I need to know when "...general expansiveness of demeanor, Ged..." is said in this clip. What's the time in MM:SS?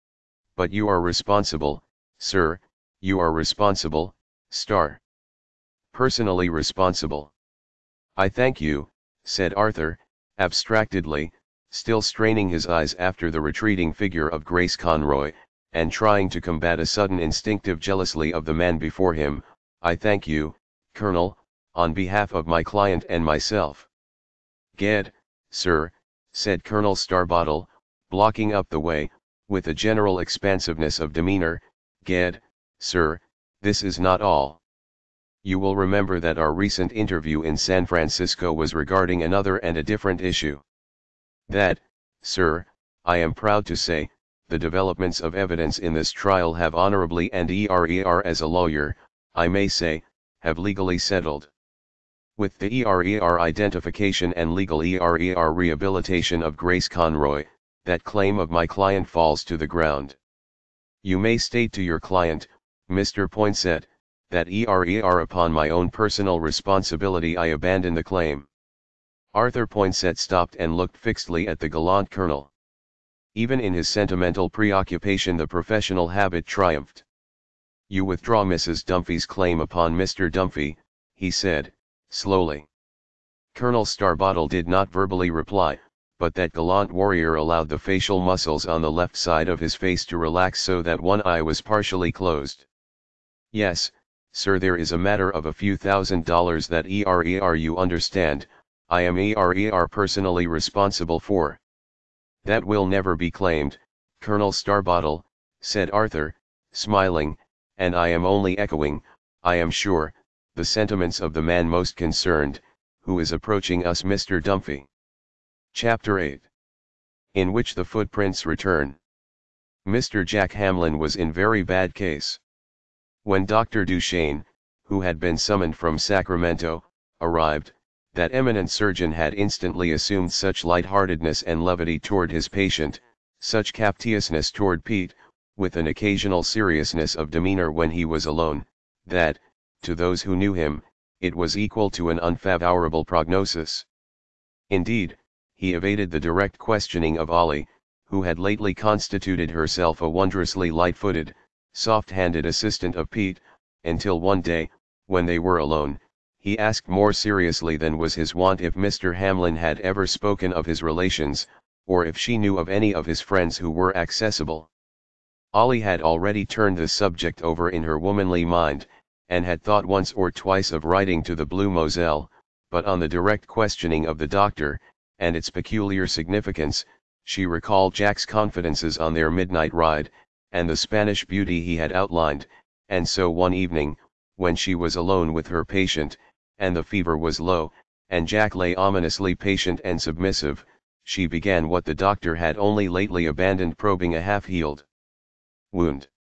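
00:29.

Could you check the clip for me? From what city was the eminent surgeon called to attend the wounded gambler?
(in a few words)
Sacramento.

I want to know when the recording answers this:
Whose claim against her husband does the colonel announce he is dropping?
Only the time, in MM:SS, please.
01:18.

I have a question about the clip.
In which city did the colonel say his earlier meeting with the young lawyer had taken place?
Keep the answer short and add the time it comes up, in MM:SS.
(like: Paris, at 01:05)
San Francisco, at 00:37.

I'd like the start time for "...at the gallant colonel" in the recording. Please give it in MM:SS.
01:11.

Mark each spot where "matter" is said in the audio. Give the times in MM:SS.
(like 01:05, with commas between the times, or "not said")
01:34.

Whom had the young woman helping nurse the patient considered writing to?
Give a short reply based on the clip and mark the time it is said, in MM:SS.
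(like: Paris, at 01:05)
the Blue Moselle, at 02:51.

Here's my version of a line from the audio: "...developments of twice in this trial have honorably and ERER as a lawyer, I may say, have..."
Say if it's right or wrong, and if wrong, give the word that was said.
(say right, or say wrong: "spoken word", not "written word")
wrong: "evidence", not "twice".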